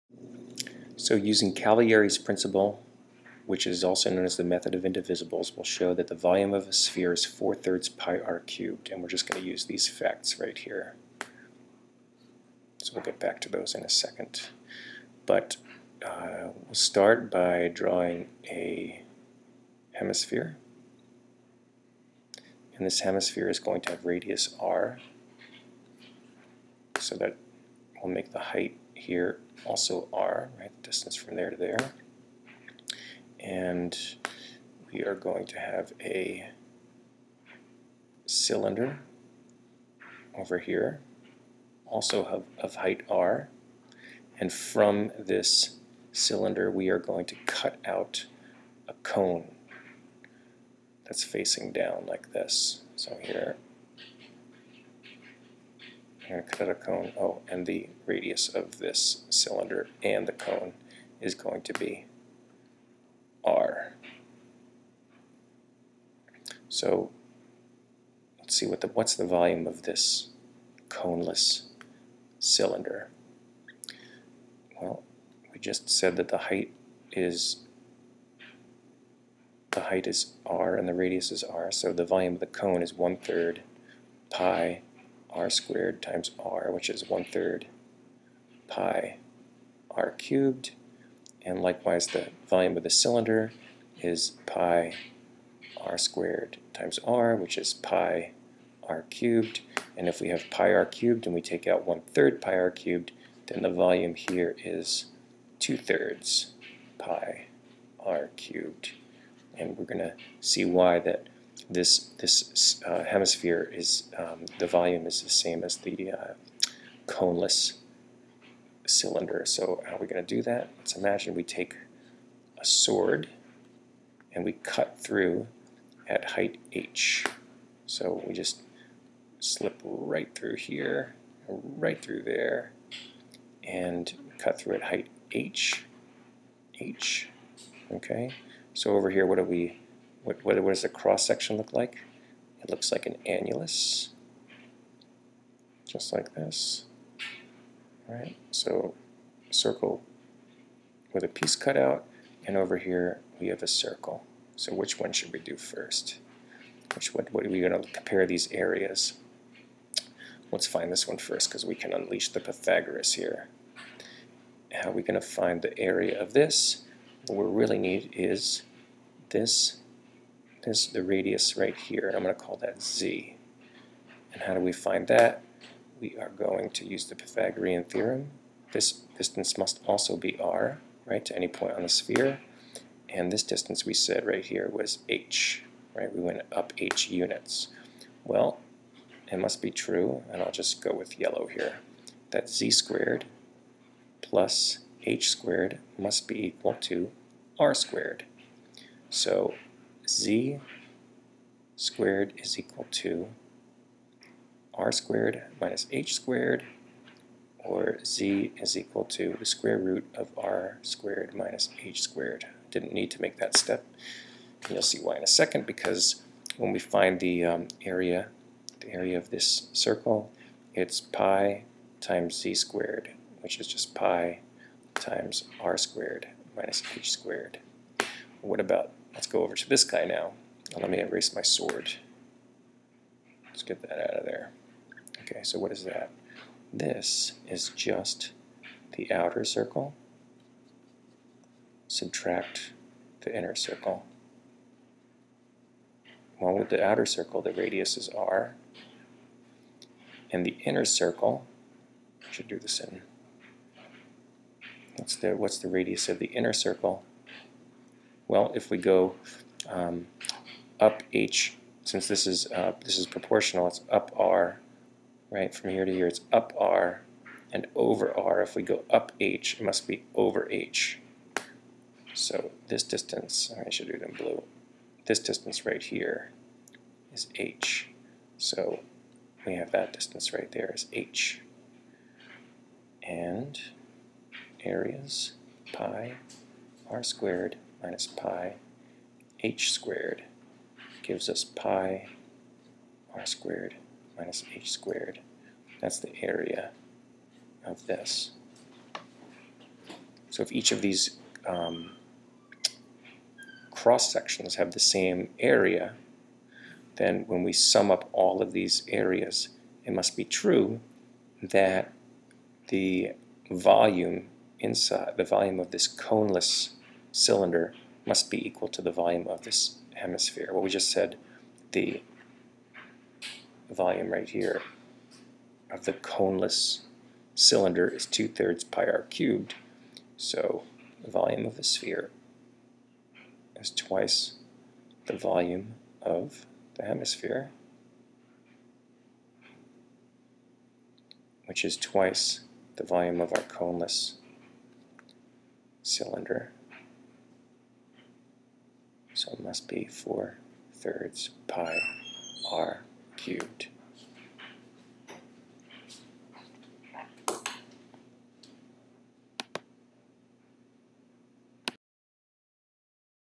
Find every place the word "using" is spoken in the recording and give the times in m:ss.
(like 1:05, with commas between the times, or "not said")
0:01.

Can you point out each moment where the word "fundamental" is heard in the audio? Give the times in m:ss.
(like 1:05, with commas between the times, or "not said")
not said.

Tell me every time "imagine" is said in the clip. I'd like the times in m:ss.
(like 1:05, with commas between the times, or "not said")
2:00.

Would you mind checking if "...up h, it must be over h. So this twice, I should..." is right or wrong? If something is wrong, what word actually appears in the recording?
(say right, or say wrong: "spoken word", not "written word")
wrong: "distance", not "twice".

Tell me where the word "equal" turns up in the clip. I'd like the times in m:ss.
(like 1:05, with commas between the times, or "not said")
3:16, 3:22, 3:28, 5:18.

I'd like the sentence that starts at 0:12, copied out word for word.
So we'll get back to those in a second.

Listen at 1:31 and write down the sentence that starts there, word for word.
And likewise, the volume of the cylinder is pi r squared times r, which is pi r cubed.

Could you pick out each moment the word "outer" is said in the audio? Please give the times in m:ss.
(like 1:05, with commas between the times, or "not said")
3:59, 4:06.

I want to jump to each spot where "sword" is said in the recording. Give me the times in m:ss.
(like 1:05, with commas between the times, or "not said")
2:02, 3:51.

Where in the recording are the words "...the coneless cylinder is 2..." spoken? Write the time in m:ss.
5:25.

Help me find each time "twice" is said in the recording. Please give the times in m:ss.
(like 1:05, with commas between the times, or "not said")
5:33, 5:41.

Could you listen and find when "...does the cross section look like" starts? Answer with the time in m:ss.
2:20.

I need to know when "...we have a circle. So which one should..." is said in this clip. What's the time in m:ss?
2:33.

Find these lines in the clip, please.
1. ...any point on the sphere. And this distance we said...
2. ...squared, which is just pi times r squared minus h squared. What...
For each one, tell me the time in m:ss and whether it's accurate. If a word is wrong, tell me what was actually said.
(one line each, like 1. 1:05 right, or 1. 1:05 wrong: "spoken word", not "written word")
1. 3:01 right
2. 3:42 right.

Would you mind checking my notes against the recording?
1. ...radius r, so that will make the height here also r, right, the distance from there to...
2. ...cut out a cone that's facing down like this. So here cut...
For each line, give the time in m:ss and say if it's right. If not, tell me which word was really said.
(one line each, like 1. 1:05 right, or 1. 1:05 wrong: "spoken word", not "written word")
1. 0:24 right
2. 0:47 right.